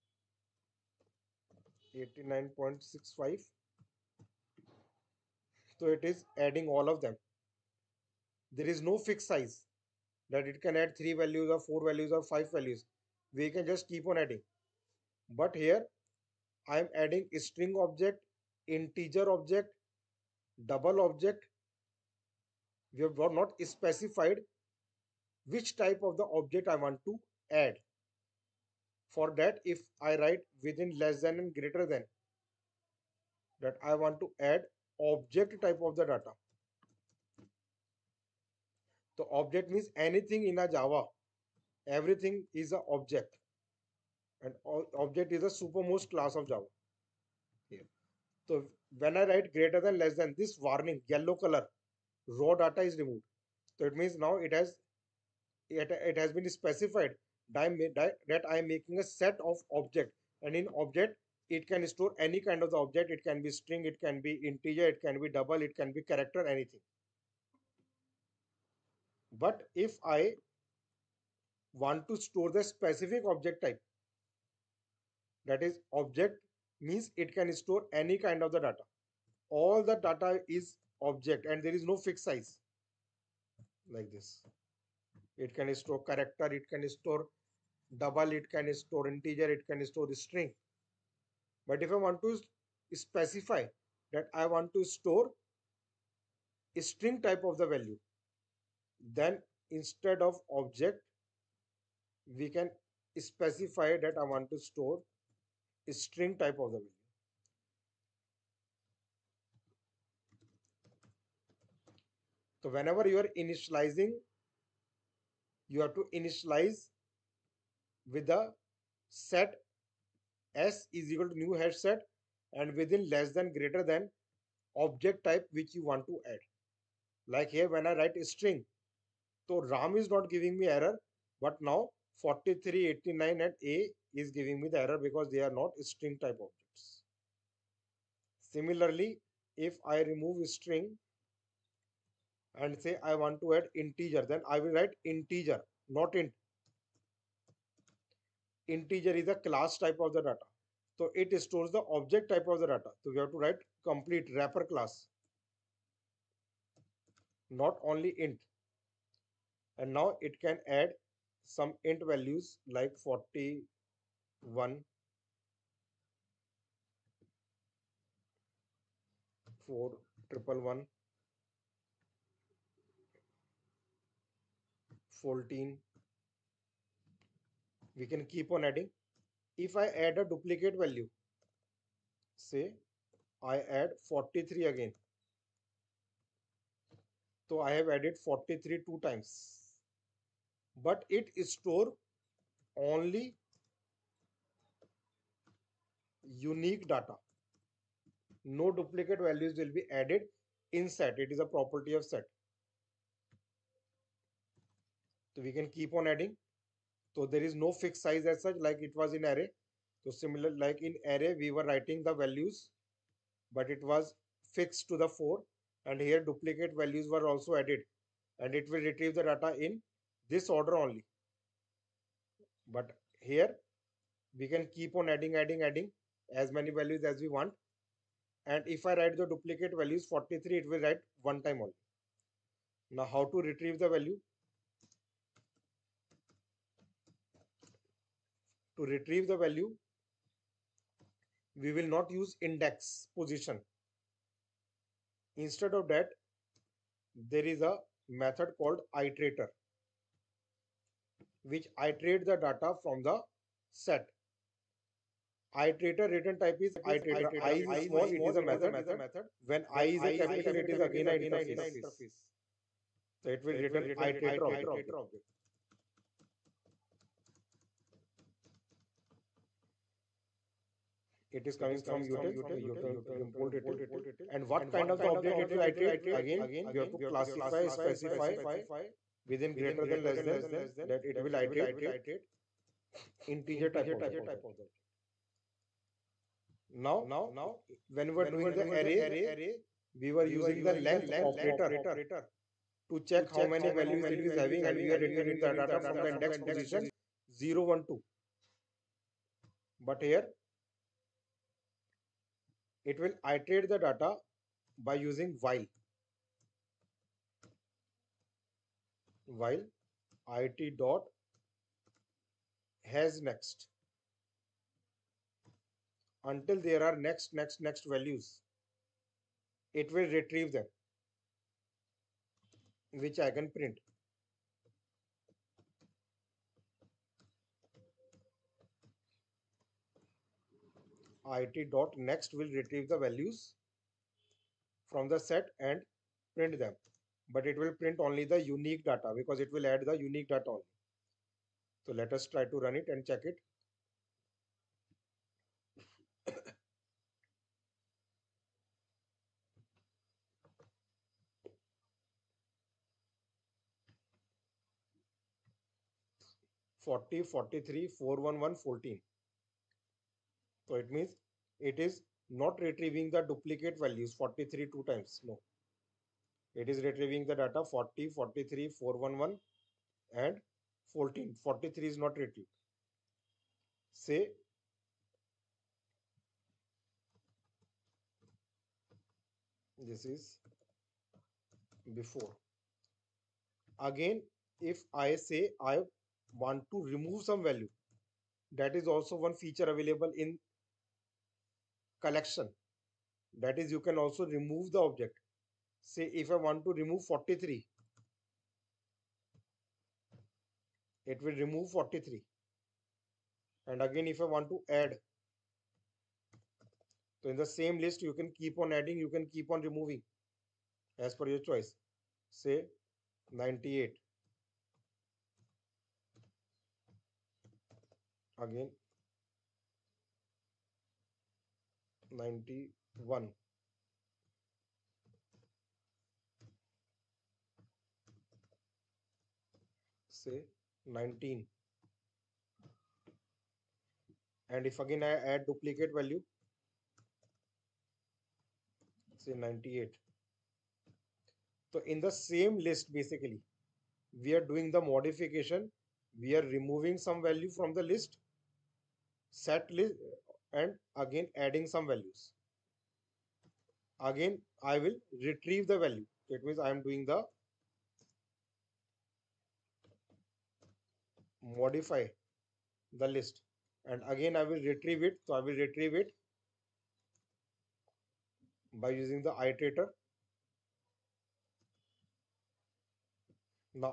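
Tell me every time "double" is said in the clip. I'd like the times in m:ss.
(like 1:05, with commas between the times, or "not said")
0:20, 1:05, 1:28.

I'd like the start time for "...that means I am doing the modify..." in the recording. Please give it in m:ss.
7:36.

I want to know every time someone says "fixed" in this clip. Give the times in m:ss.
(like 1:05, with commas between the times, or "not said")
0:08, 1:22, 3:27, 3:34.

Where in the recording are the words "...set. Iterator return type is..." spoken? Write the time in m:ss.
4:13.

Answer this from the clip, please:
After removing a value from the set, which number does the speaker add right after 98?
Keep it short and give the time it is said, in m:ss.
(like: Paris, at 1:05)
91, at 7:02.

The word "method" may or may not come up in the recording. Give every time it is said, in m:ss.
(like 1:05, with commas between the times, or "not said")
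4:08, 4:18.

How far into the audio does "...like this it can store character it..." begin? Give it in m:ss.
1:23.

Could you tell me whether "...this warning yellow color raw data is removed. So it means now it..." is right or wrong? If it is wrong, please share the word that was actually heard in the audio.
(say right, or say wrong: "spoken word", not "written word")
right.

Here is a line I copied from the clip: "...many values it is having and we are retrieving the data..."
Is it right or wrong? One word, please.
right.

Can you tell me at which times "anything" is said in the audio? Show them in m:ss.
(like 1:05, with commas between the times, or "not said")
0:39, 1:06.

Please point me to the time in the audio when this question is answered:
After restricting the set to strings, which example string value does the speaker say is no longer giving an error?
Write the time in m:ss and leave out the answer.
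2:09.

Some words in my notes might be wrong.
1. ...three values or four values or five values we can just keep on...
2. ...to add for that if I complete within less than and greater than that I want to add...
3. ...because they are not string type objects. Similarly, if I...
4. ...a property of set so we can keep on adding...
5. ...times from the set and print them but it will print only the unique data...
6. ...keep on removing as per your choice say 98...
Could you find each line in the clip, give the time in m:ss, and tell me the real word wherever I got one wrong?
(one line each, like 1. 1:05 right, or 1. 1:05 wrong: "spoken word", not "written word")
1. 0:10 right
2. 0:27 wrong: "write", not "complete"
3. 2:14 right
4. 3:21 right
5. 5:32 wrong: "values", not "times"
6. 6:49 right.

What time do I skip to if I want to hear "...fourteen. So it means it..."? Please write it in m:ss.
5:58.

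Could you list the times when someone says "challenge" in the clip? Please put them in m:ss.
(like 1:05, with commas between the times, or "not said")
not said.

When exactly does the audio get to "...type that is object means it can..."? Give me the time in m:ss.
1:13.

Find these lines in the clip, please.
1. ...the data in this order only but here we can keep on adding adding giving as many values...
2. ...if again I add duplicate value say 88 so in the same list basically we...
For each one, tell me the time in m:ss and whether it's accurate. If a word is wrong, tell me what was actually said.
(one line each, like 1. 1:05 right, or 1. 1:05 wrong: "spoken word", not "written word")
1. 3:39 wrong: "adding", not "giving"
2. 7:14 wrong: "98", not "88".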